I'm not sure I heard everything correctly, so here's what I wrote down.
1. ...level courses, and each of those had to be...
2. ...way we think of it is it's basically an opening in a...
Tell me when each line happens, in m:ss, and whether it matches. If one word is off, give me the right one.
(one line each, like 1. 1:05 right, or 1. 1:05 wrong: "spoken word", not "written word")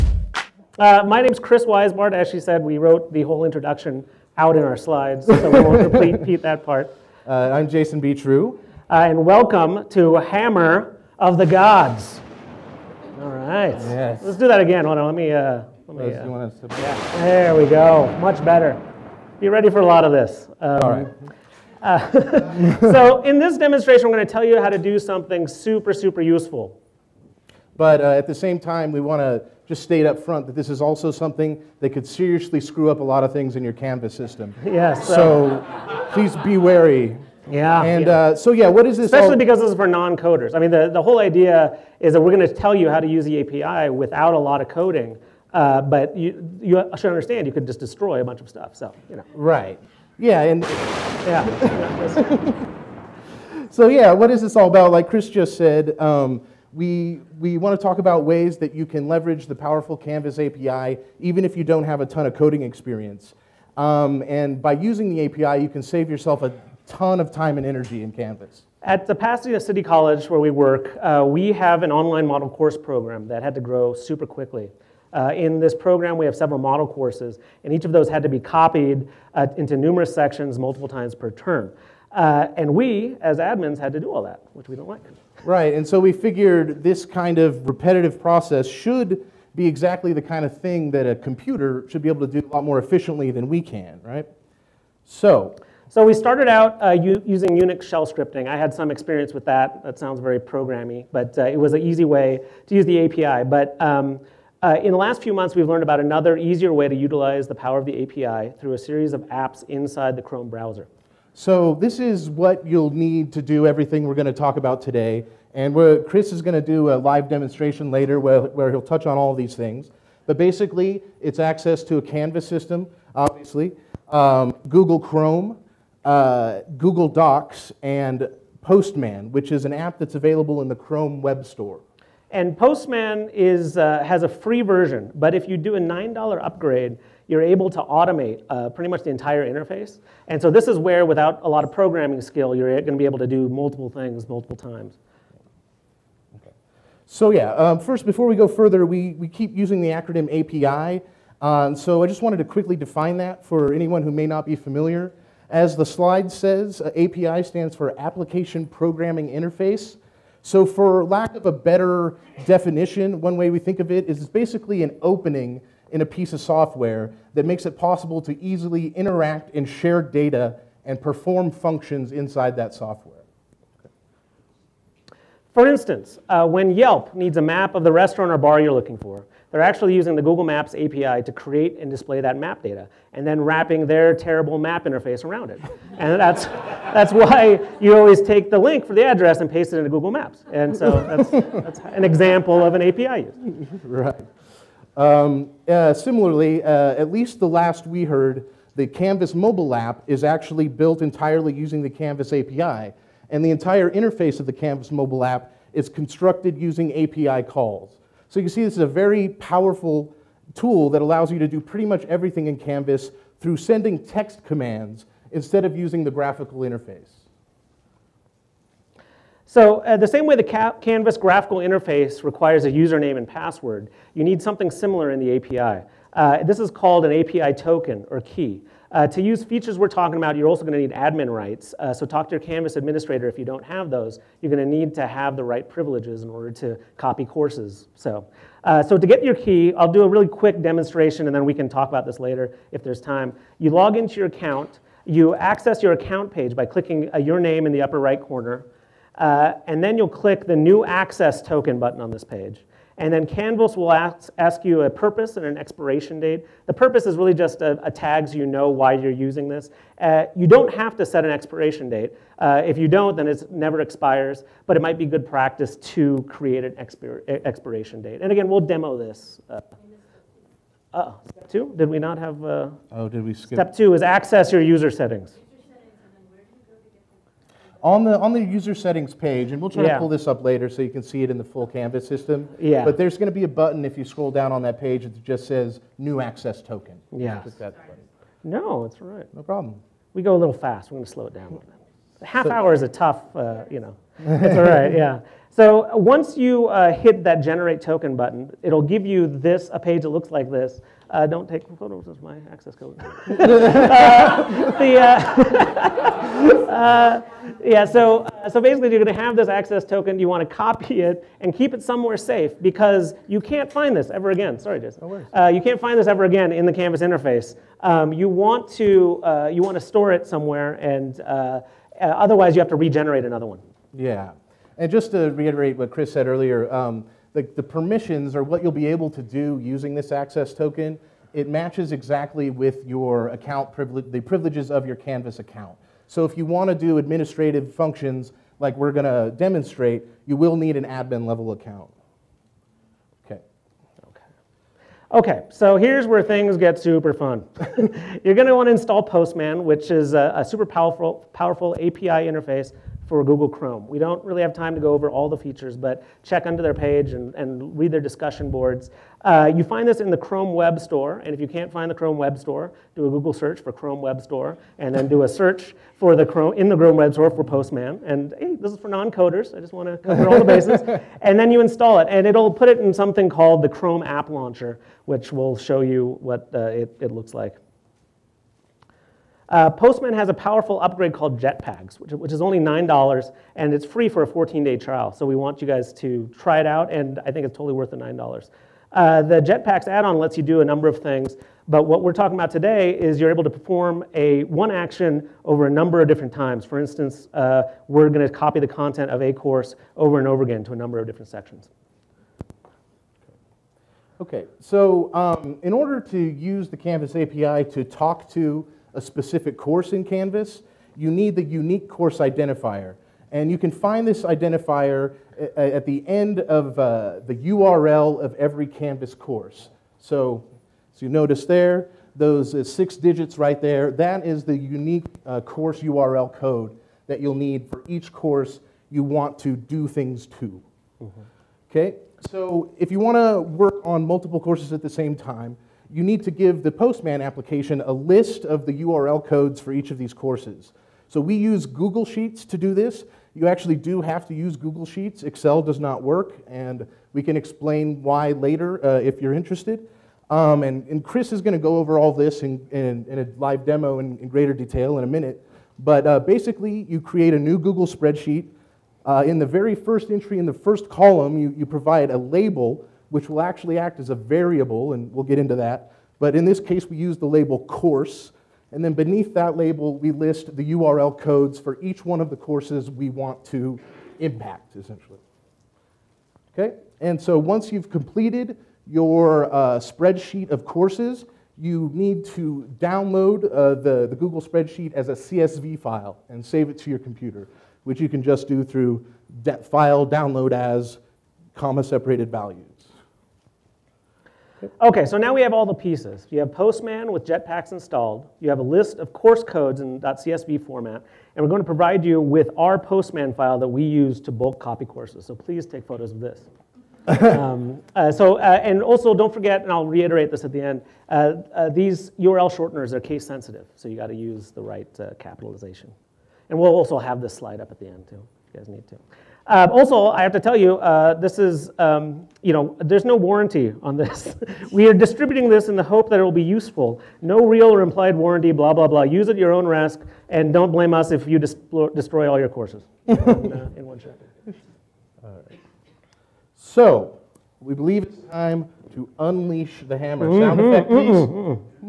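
1. 1:16 wrong: "model", not "level"
2. 2:43 right.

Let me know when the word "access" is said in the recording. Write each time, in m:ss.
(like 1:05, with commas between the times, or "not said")
2:01, 4:05, 4:10, 4:34, 4:46, 5:02, 5:09, 5:30.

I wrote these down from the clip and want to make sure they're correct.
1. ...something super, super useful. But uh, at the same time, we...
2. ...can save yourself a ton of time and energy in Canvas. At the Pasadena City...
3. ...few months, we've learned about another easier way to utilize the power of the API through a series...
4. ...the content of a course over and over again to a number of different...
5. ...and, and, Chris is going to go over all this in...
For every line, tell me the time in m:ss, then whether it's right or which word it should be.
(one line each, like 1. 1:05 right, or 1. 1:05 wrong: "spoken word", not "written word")
1. 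0:24 right
2. 1:05 right
3. 1:45 right
4. 6:38 right
5. 7:30 right.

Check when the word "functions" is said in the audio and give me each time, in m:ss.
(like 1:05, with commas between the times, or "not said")
2:51, 5:37.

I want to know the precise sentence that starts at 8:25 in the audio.
So please take photos of this.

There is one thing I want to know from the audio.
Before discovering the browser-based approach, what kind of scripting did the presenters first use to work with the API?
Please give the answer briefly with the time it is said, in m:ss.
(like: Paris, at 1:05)
Unix shell scripting, at 1:37.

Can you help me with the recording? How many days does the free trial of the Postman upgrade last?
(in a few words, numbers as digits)
14.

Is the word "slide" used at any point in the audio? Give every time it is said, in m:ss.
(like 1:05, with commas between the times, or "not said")
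0:04, 2:35, 8:37.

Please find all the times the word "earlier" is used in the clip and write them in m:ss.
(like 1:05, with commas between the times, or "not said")
5:26.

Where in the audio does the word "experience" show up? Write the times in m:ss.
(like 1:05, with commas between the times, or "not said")
1:02, 1:38.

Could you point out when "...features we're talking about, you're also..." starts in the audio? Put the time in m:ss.
3:49.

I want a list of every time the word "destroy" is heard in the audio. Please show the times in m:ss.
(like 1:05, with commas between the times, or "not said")
0:47, 8:51.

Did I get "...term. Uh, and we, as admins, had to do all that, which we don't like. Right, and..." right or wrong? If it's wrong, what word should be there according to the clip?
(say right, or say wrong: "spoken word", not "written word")
right.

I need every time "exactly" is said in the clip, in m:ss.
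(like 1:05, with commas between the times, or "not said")
1:29, 5:31.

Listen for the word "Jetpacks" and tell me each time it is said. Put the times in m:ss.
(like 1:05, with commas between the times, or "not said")
6:21, 6:29, 8:17.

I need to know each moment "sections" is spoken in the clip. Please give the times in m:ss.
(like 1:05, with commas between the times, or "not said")
1:20, 6:41.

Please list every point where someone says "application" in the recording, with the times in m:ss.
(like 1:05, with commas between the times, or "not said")
2:37, 7:17.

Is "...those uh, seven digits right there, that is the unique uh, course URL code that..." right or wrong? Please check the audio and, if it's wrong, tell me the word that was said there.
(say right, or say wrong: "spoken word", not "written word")
wrong: "six", not "seven".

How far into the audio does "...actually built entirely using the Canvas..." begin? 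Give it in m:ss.
3:20.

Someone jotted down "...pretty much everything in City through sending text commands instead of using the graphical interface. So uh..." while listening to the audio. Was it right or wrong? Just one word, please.
wrong.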